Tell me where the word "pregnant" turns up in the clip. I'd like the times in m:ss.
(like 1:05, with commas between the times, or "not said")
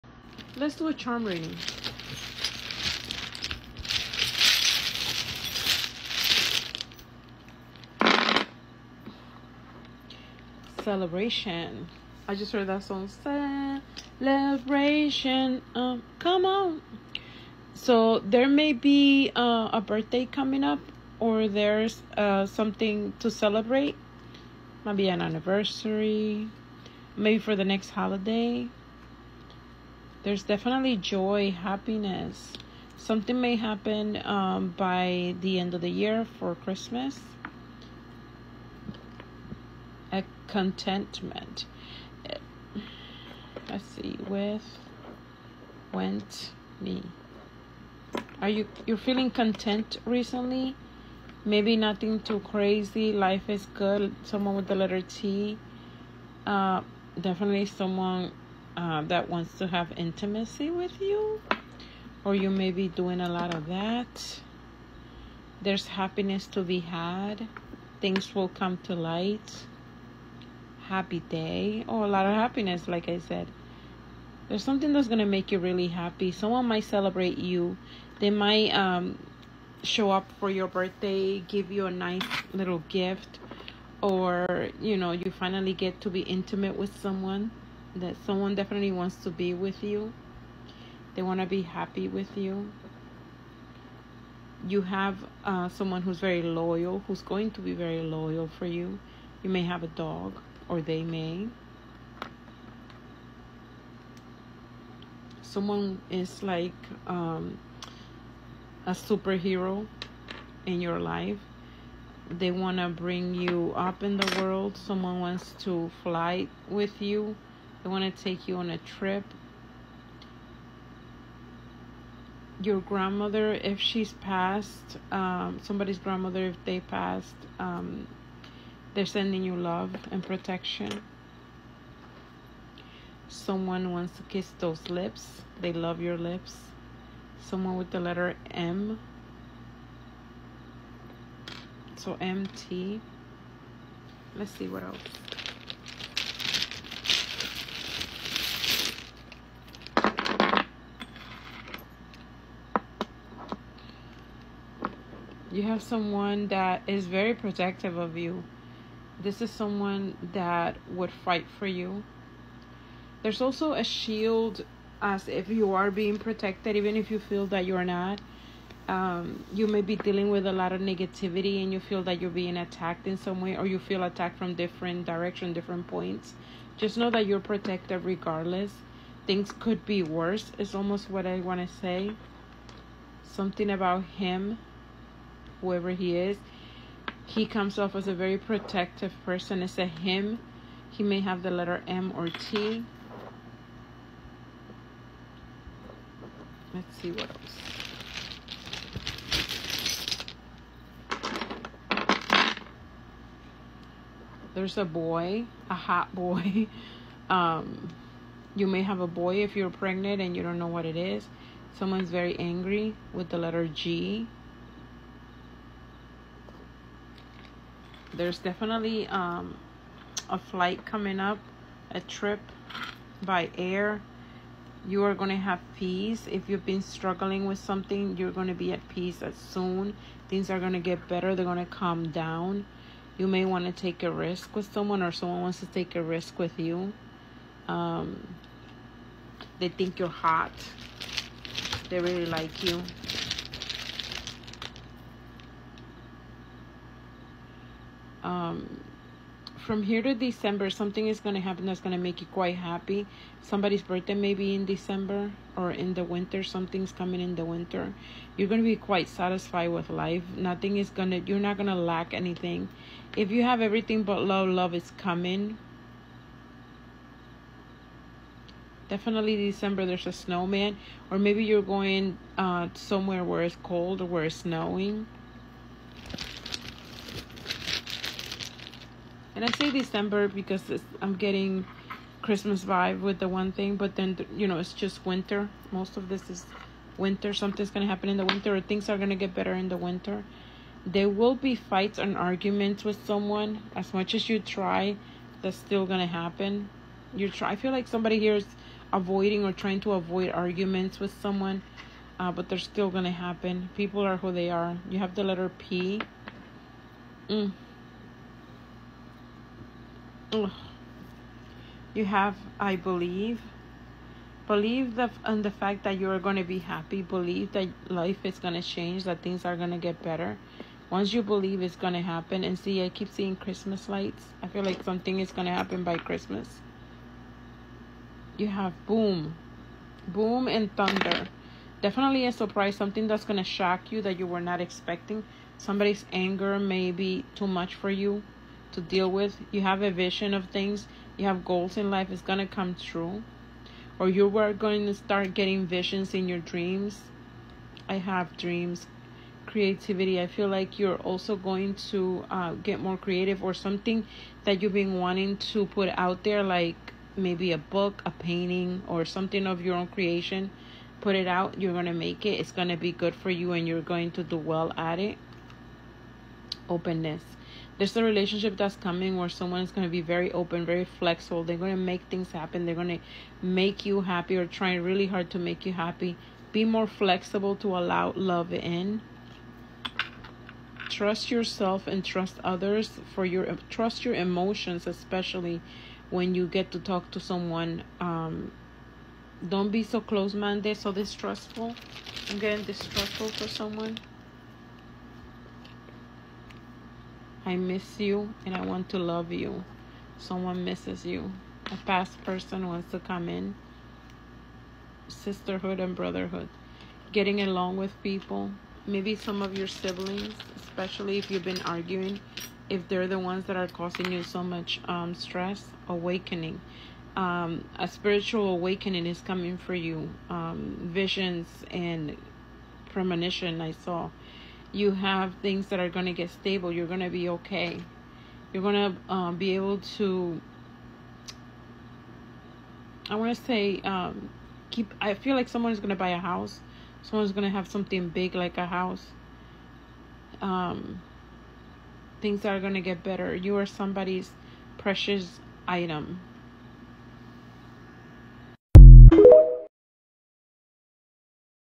3:29.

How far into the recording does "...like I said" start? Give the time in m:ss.
1:12.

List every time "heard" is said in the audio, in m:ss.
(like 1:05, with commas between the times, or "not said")
0:12.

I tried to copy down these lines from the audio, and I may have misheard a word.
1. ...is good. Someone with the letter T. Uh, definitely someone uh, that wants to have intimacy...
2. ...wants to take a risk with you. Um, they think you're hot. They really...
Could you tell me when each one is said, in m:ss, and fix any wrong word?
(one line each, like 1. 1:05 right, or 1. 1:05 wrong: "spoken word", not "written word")
1. 0:53 right
2. 3:55 right.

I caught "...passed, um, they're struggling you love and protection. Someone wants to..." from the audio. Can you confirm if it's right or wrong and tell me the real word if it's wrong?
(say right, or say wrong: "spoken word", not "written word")
wrong: "sending", not "struggling".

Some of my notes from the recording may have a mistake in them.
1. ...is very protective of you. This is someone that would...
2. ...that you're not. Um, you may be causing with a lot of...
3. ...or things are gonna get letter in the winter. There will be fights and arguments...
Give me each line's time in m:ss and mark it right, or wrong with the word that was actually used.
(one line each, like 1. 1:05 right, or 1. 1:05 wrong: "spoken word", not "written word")
1. 2:36 right
2. 2:47 wrong: "dealing", not "causing"
3. 4:48 wrong: "better", not "letter".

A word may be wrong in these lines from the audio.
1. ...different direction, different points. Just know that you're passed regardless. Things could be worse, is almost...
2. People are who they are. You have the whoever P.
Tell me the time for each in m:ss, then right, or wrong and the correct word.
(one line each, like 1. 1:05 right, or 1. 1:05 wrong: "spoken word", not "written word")
1. 2:54 wrong: "protected", not "passed"
2. 5:03 wrong: "letter", not "whoever".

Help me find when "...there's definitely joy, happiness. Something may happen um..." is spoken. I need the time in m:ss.
0:30.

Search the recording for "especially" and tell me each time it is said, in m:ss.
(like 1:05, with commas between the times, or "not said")
6:24, 6:50.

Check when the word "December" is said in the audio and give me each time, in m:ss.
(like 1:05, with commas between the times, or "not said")
4:10, 4:14, 4:29, 4:39.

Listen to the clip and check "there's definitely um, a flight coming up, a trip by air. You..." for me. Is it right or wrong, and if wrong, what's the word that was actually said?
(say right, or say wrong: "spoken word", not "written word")
right.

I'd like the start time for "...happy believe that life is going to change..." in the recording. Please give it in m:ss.
5:16.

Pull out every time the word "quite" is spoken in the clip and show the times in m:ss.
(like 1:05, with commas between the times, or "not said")
4:12, 4:18.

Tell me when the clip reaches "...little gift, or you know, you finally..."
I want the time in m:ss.
1:22.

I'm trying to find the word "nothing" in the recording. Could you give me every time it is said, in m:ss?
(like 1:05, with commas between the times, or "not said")
0:51, 4:20.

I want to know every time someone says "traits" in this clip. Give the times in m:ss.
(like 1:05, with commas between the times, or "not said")
not said.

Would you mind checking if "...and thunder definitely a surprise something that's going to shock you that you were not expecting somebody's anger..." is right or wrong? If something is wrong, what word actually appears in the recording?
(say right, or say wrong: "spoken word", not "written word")
right.